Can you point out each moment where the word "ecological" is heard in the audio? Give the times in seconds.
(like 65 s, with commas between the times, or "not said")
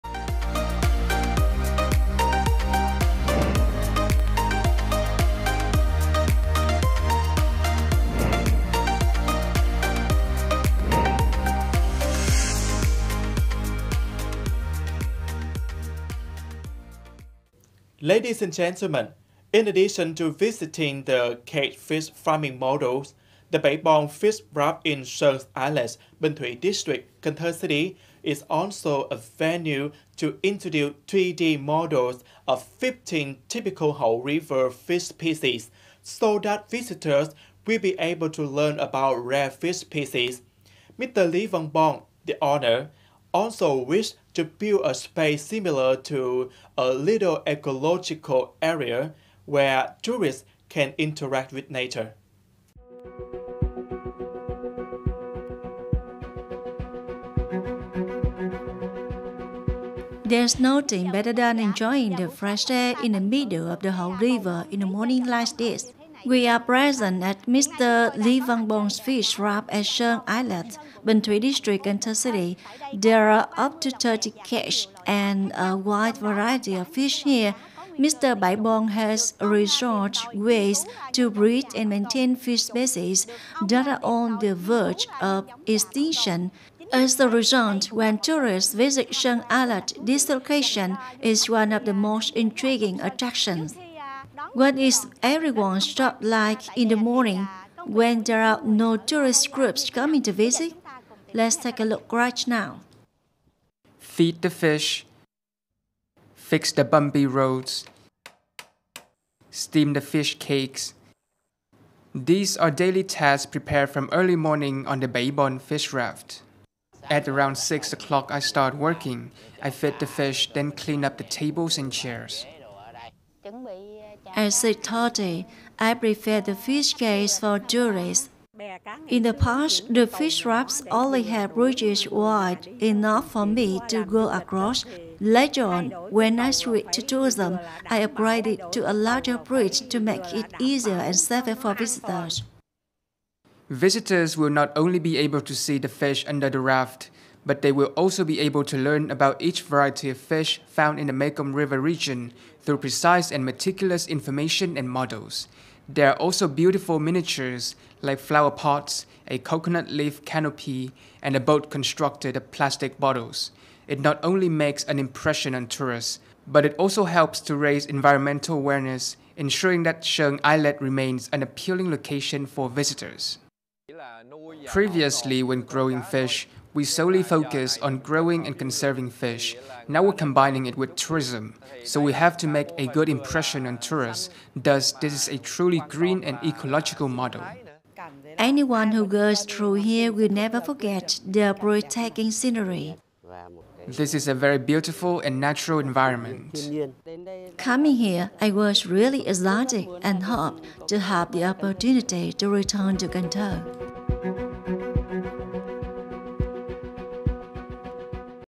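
47 s, 186 s.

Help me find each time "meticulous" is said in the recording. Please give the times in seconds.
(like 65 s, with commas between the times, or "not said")
153 s.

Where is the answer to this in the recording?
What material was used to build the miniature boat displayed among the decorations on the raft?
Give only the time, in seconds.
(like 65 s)
162 s.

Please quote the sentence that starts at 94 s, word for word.
What is everyone's job like in the morning when there are no tourist groups coming to visit?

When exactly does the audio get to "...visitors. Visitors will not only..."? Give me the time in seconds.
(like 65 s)
141 s.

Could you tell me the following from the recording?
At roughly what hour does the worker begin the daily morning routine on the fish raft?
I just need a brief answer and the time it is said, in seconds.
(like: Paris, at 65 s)
6 o'clock, at 117 s.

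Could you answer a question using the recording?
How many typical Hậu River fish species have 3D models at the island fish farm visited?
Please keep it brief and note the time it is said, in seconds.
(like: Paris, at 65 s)
15, at 32 s.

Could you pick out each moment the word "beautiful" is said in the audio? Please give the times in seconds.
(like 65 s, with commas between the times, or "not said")
156 s, 194 s.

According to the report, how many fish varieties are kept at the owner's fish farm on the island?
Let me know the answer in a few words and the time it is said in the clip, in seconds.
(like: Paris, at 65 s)
30, at 73 s.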